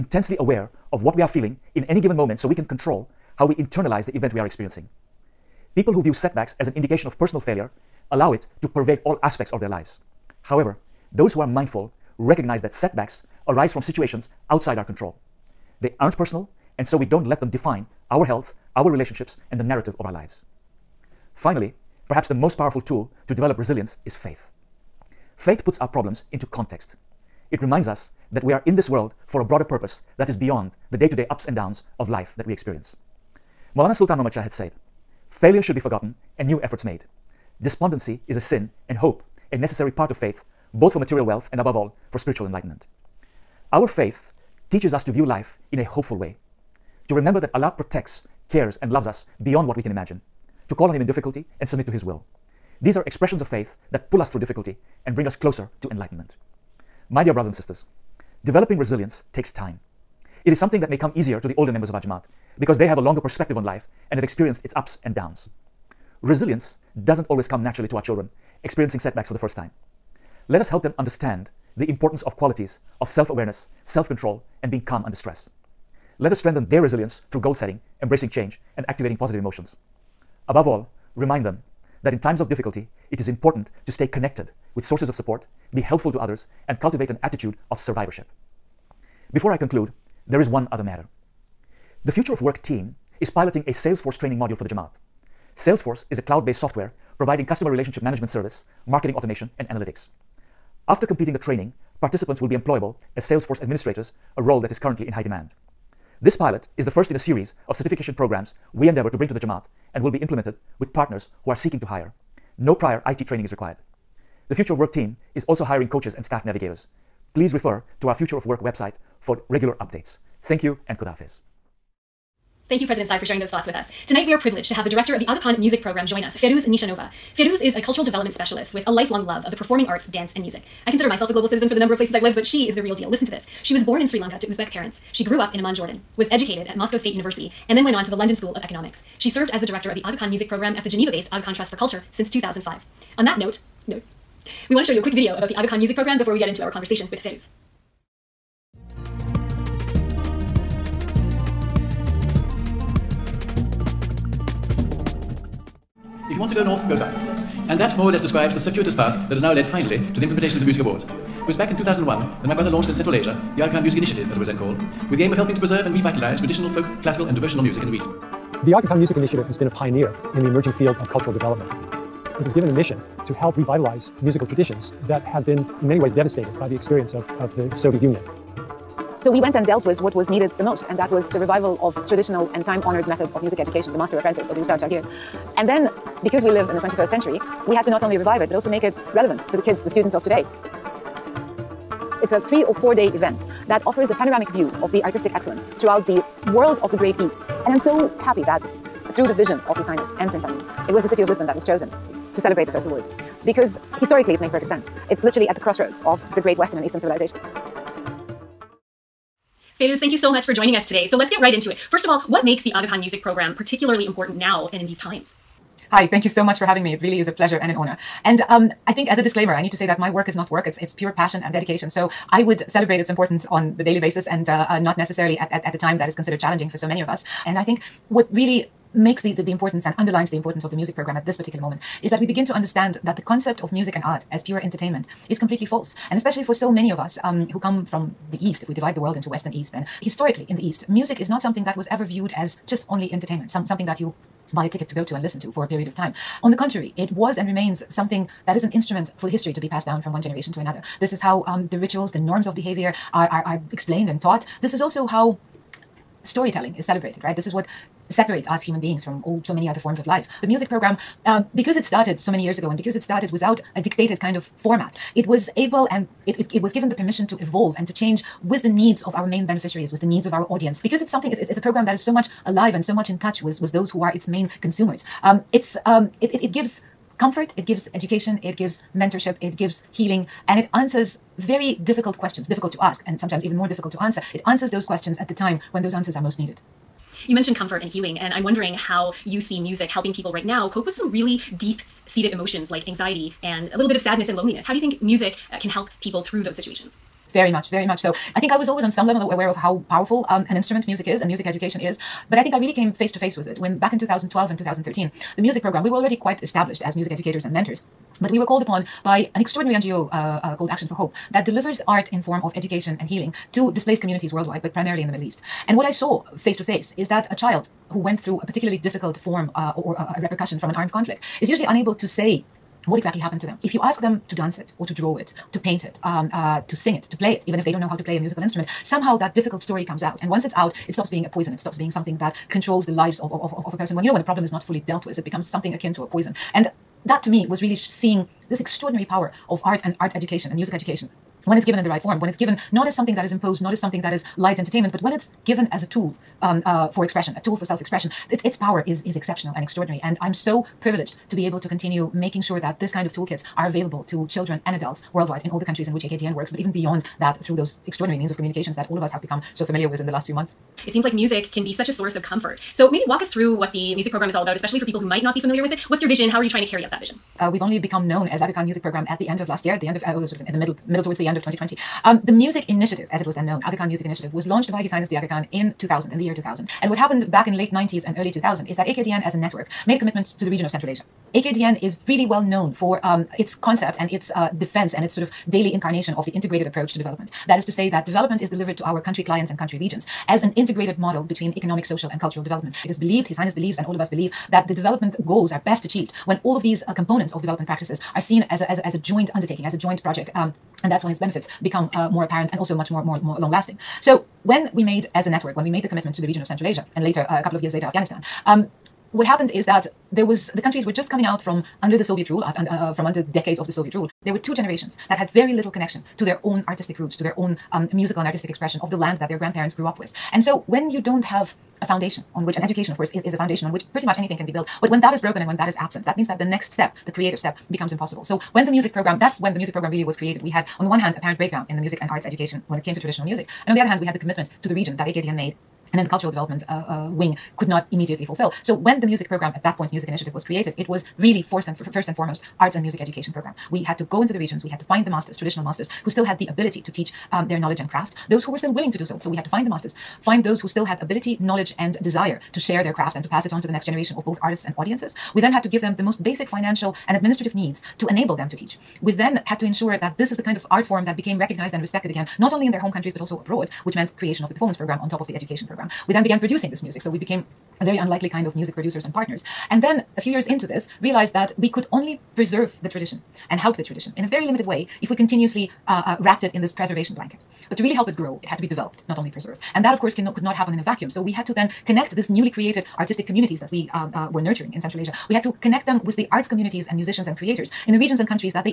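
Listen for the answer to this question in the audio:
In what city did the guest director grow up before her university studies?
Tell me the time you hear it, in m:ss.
2:15.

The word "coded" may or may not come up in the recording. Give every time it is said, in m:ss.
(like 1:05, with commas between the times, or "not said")
not said.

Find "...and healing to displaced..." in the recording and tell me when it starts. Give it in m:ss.
5:12.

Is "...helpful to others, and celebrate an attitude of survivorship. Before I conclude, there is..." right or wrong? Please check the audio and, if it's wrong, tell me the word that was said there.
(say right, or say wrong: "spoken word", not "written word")
wrong: "cultivate", not "celebrate".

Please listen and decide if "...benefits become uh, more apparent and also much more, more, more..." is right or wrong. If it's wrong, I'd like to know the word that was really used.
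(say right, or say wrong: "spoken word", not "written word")
right.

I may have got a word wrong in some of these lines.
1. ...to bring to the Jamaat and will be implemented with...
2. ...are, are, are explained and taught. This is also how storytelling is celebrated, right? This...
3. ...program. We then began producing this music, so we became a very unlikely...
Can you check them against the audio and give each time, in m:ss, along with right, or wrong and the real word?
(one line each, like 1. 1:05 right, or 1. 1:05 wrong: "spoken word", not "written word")
1. 1:49 right
2. 4:13 right
3. 7:45 right.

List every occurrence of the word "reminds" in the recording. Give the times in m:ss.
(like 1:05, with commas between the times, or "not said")
0:27, 1:21.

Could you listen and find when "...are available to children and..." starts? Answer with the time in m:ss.
5:53.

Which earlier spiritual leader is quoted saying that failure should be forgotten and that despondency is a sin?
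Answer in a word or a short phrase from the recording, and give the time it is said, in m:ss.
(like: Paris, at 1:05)
Maulana Sultan Muhammad, at 0:33.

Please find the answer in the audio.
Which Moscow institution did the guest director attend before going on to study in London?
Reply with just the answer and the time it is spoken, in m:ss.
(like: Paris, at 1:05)
Moscow State University, at 2:16.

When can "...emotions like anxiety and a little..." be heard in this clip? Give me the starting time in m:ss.
4:52.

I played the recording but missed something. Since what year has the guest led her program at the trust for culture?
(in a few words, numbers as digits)
2005.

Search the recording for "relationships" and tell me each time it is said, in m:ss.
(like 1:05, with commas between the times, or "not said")
0:18, 1:37.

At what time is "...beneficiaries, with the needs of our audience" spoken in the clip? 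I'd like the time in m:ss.
4:29.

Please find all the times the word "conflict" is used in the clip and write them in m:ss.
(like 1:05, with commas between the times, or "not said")
5:20.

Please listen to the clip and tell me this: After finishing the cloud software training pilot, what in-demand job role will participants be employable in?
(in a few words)
Salesforce administrators.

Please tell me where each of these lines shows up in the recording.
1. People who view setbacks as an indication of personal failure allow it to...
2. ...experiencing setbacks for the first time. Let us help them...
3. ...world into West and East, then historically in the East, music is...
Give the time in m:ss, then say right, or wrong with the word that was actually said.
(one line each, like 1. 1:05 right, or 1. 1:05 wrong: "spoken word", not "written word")
1. 0:05 right
2. 1:08 right
3. 3:58 right.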